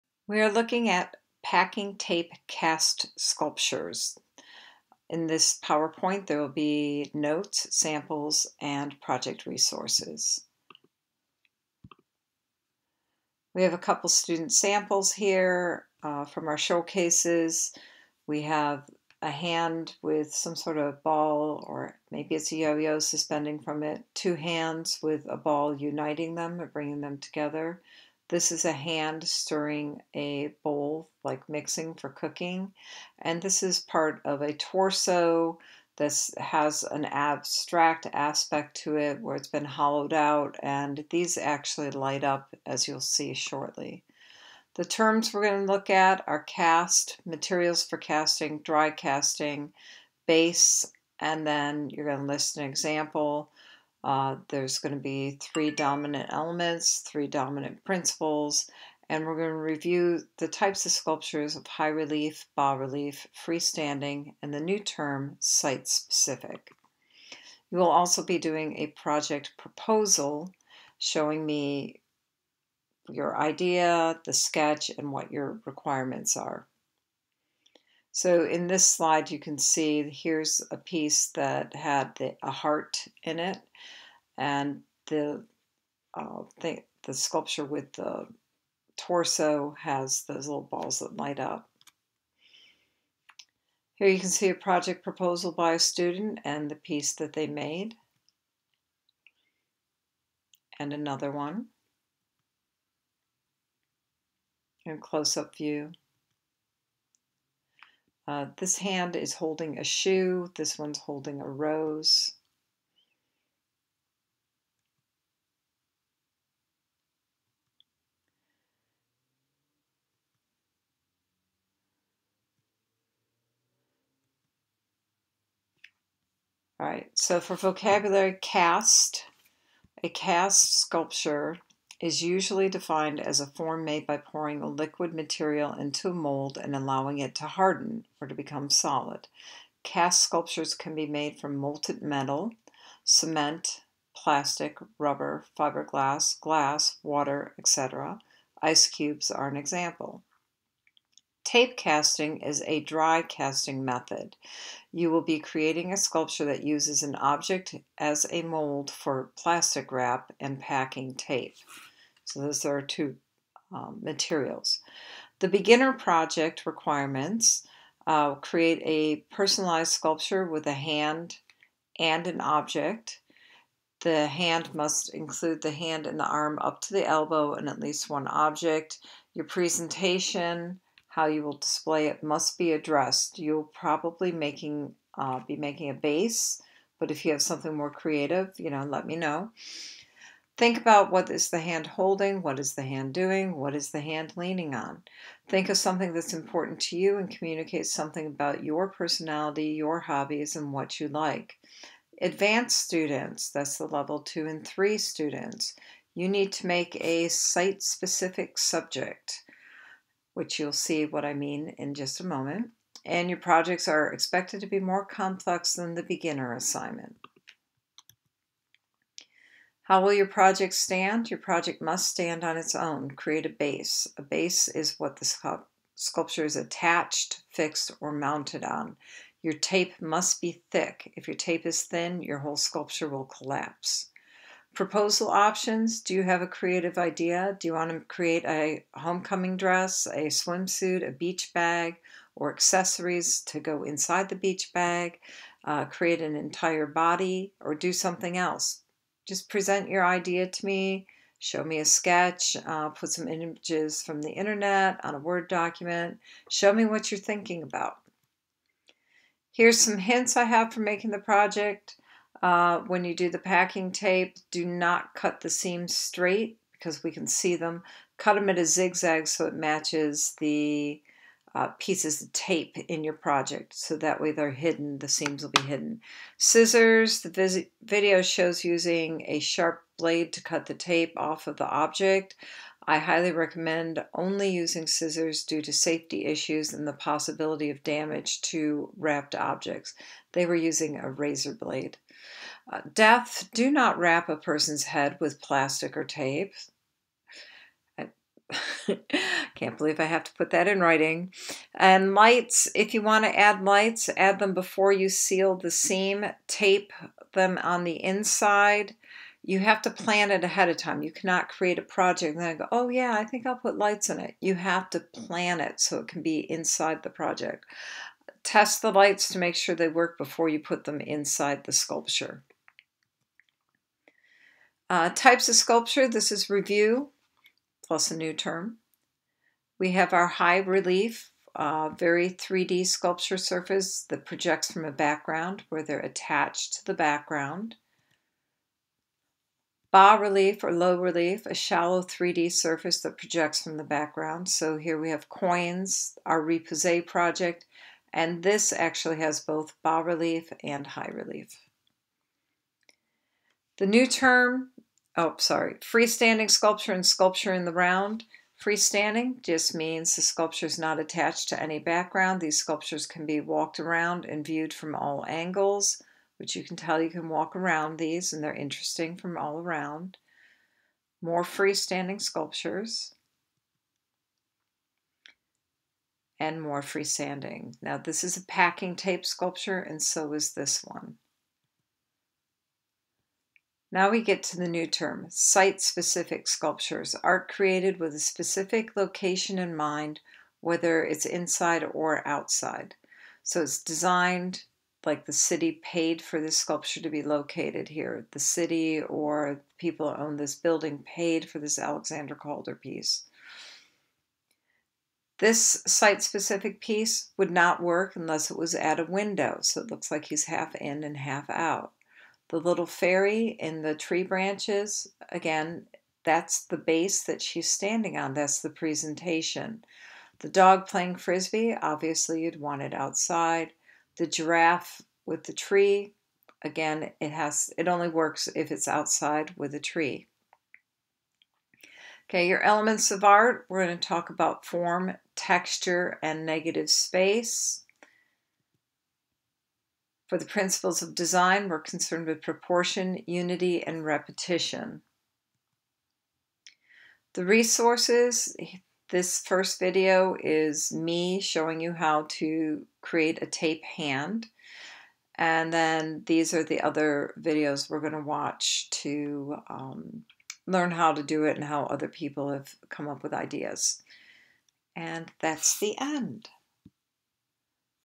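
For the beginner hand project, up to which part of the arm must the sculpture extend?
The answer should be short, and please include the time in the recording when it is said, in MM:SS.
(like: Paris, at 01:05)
the elbow, at 02:56.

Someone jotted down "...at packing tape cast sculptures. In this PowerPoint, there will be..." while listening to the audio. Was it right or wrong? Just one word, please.
right.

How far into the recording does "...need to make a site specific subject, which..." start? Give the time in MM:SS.
03:26.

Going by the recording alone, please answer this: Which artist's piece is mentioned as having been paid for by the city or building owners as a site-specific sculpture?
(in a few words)
Alexander Calder.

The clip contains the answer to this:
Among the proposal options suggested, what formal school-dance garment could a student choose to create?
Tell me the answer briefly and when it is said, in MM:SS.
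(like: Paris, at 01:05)
homecoming dress, at 03:58.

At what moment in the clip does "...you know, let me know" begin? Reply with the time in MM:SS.
03:08.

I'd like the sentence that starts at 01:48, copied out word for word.
Uh, this hand is holding a shoe, this one's holding a rose.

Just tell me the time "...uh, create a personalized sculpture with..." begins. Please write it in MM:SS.
02:48.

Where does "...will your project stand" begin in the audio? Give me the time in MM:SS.
03:40.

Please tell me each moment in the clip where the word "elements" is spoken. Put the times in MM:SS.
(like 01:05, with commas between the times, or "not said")
00:56, 07:12.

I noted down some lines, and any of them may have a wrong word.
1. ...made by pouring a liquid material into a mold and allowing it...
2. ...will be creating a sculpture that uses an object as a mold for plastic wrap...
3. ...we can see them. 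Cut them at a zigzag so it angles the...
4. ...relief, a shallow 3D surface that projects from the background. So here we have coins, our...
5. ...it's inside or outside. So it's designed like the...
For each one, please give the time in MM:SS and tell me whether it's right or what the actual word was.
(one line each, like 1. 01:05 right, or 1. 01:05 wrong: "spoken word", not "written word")
1. 02:13 right
2. 02:35 right
3. 04:27 wrong: "matches", not "angles"
4. 05:41 right
5. 06:31 right.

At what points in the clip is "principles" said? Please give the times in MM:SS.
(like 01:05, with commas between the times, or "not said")
00:57, 07:20.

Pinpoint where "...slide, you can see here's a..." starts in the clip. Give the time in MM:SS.
01:18.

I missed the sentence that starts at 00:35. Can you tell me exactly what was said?
This has an abstract aspect to it where it's been hollowed out, and these actually light up as you'll see shortly.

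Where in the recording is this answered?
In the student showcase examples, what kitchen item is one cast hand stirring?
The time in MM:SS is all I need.
00:30.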